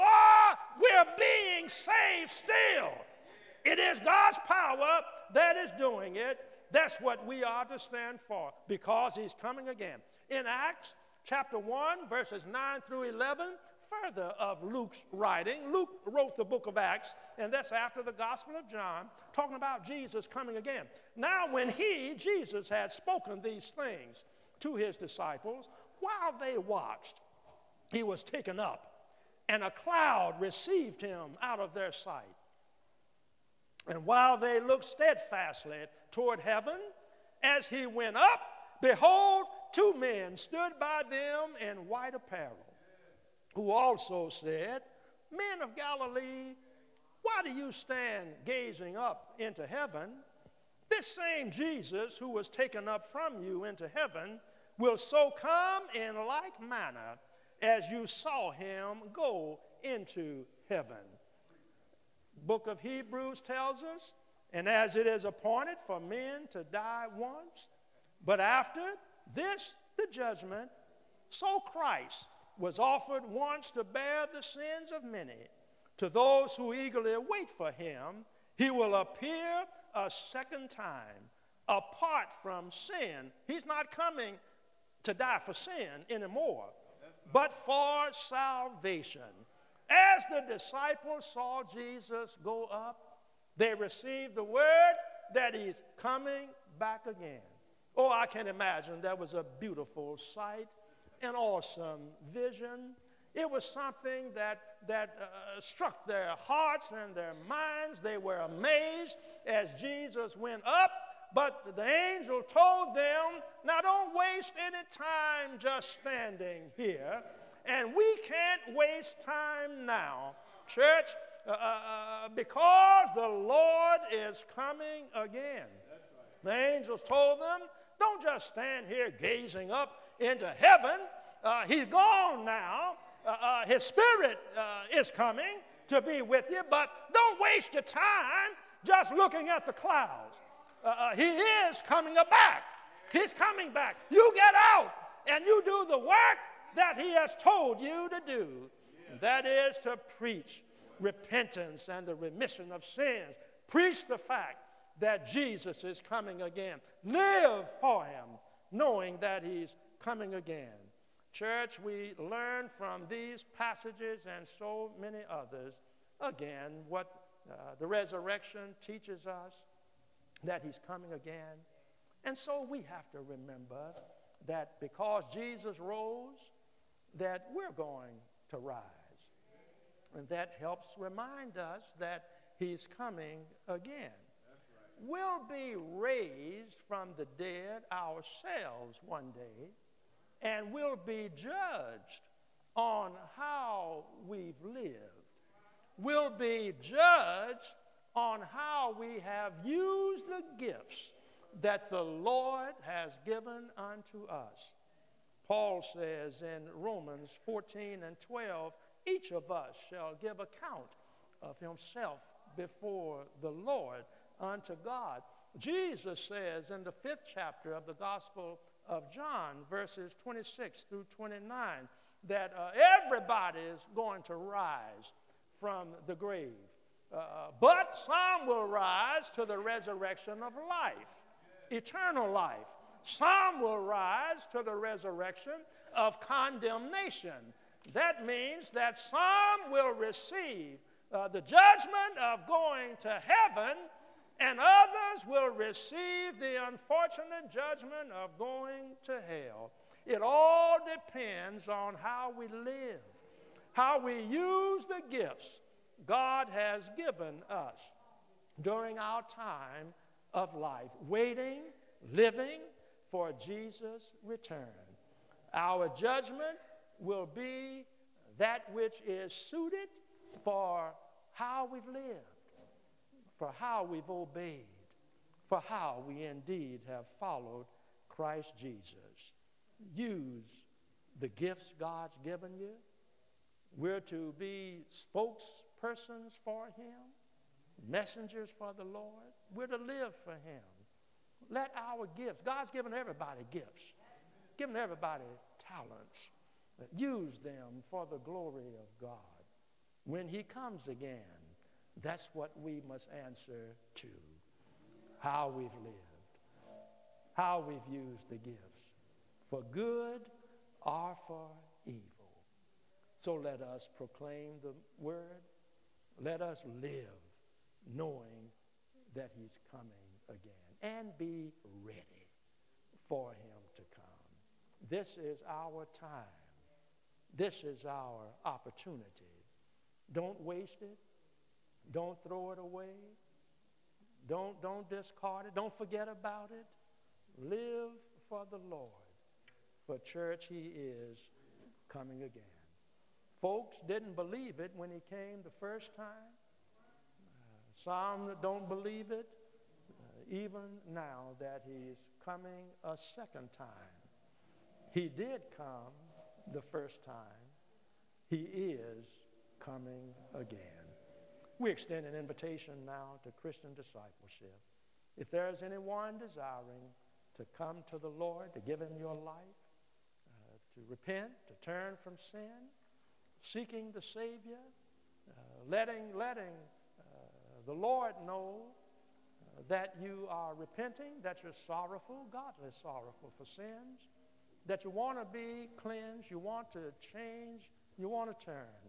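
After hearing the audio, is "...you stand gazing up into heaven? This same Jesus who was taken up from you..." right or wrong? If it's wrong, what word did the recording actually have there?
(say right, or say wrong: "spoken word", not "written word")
right.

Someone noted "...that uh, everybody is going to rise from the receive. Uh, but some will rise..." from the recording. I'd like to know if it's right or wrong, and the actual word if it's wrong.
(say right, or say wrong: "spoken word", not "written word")
wrong: "grave", not "receive".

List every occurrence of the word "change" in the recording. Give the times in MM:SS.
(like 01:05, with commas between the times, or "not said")
06:27.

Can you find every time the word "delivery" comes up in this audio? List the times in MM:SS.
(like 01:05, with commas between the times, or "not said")
not said.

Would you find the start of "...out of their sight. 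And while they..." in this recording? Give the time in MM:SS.
00:31.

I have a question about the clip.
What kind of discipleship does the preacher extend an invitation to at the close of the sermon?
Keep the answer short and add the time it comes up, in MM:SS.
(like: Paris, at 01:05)
Christian discipleship, at 06:03.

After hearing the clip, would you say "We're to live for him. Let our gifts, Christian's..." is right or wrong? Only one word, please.
wrong.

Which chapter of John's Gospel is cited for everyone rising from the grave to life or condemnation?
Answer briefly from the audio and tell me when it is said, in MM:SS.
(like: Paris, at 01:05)
fifth chapter, at 03:36.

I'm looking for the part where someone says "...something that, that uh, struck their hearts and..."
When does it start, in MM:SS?
01:43.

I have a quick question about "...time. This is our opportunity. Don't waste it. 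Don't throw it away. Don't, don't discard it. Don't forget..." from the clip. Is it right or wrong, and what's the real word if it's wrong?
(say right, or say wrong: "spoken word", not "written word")
right.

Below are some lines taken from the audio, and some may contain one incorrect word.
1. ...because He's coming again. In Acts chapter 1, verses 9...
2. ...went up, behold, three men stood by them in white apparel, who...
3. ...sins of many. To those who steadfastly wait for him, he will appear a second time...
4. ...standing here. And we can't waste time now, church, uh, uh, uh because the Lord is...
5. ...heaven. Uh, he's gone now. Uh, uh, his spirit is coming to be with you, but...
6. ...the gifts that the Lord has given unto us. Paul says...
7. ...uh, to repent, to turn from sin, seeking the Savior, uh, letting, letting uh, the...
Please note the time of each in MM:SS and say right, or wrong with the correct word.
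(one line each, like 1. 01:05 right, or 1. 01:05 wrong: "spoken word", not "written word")
1. 00:08 right
2. 00:37 wrong: "two", not "three"
3. 01:14 wrong: "eagerly", not "steadfastly"
4. 01:55 right
5. 02:10 right
6. 03:20 right
7. 06:10 right.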